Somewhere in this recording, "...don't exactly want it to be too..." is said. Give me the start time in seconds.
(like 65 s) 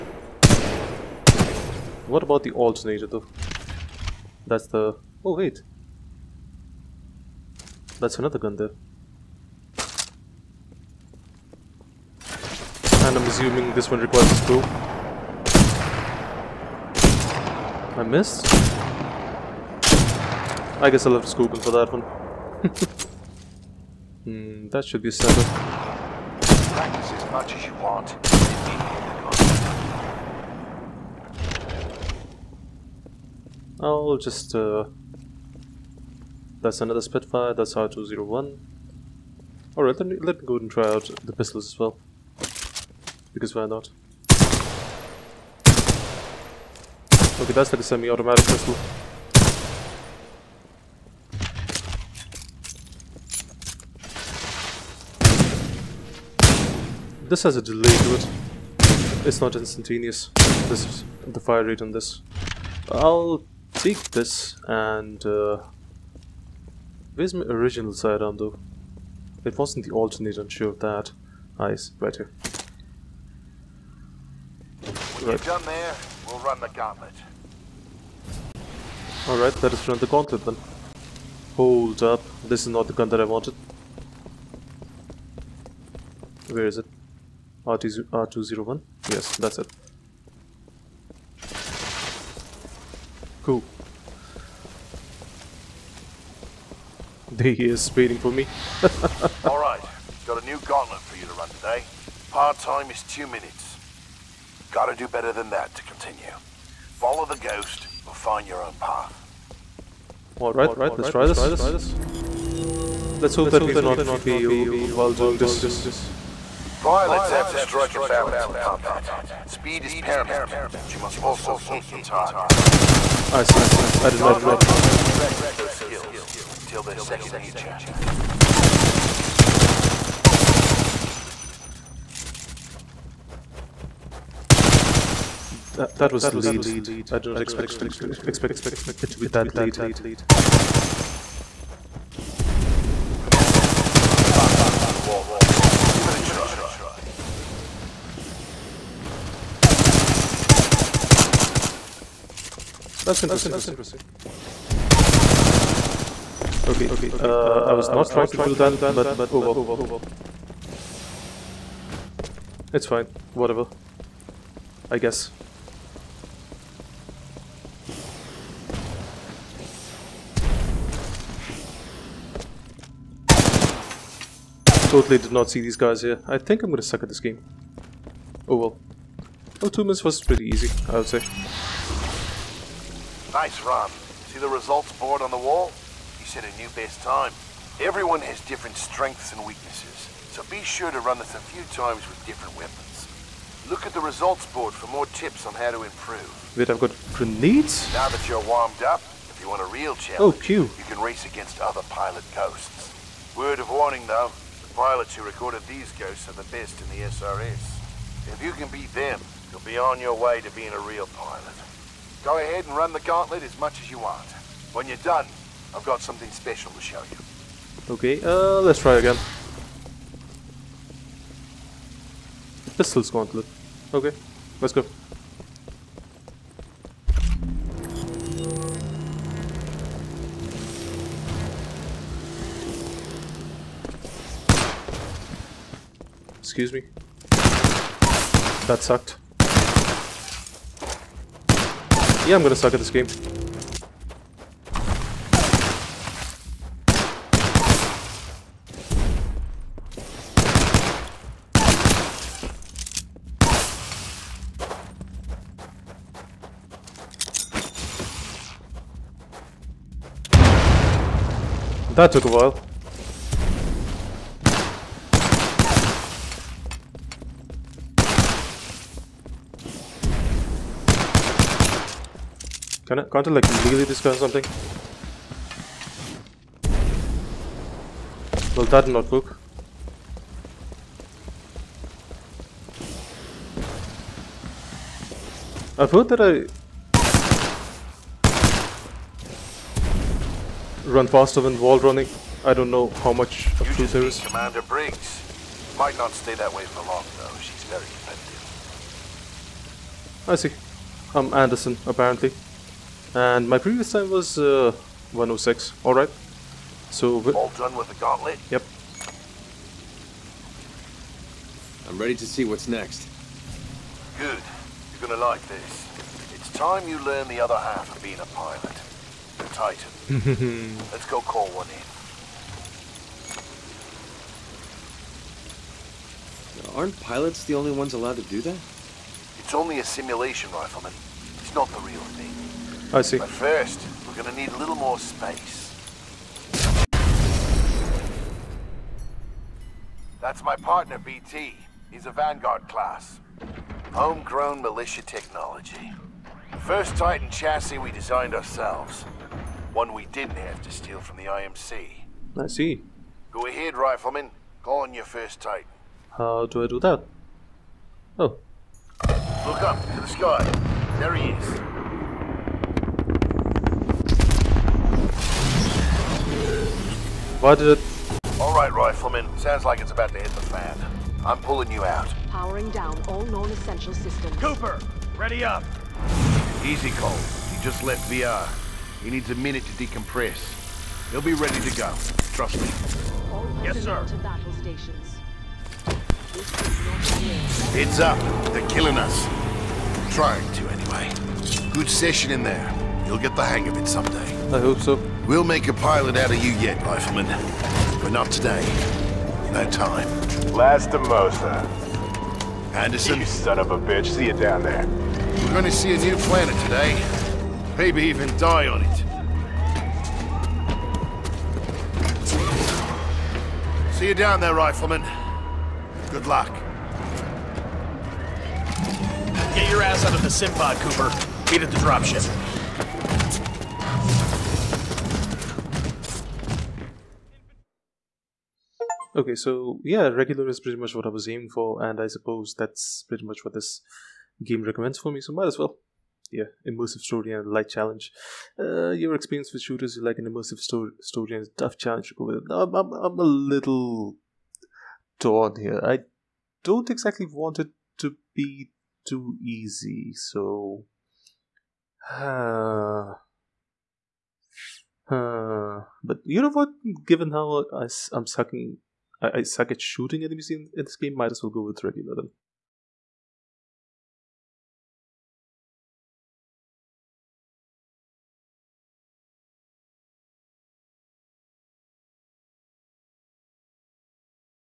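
446 s.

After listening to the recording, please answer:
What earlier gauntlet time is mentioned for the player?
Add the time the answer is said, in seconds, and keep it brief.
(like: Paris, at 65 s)
106, at 305 s.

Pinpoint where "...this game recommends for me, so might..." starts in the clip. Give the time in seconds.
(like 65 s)
433 s.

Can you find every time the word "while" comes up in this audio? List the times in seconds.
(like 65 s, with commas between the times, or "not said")
114 s, 262 s.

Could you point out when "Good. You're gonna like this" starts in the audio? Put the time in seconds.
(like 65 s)
314 s.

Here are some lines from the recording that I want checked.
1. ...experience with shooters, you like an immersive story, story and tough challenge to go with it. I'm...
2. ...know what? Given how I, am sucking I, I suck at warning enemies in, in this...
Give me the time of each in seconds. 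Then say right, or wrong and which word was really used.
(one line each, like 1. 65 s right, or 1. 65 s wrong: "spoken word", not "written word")
1. 439 s right
2. 456 s wrong: "shooting", not "warning".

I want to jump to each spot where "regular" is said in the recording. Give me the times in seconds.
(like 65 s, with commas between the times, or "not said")
430 s, 461 s.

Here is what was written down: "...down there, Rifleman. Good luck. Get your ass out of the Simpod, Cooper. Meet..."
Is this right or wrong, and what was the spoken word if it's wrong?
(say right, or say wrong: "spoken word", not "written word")
right.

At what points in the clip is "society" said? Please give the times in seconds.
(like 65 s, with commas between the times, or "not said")
not said.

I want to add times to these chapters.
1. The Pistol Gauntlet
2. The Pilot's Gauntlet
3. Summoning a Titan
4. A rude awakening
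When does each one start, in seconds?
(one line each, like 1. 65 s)
1. 217 s
2. 97 s
3. 306 s
4. 363 s.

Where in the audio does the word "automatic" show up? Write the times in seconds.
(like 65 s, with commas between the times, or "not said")
47 s.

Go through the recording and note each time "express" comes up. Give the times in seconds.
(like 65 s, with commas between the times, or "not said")
not said.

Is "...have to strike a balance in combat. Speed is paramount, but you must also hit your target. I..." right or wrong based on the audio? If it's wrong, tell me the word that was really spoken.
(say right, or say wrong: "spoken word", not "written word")
right.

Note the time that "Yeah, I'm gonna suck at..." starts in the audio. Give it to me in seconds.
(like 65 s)
242 s.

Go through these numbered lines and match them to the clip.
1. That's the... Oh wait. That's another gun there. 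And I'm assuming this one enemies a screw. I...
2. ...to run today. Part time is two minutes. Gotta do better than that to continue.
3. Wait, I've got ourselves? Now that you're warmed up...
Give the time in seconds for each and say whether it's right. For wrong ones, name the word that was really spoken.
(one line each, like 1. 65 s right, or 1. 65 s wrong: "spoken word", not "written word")
1. 4 s wrong: "requires", not "enemies"
2. 101 s right
3. 196 s wrong: "grenades", not "ourselves".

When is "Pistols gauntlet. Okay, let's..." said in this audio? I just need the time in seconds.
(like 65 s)
222 s.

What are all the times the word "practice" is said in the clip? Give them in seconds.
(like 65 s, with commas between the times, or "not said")
25 s, 124 s.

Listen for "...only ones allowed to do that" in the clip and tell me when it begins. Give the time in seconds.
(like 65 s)
327 s.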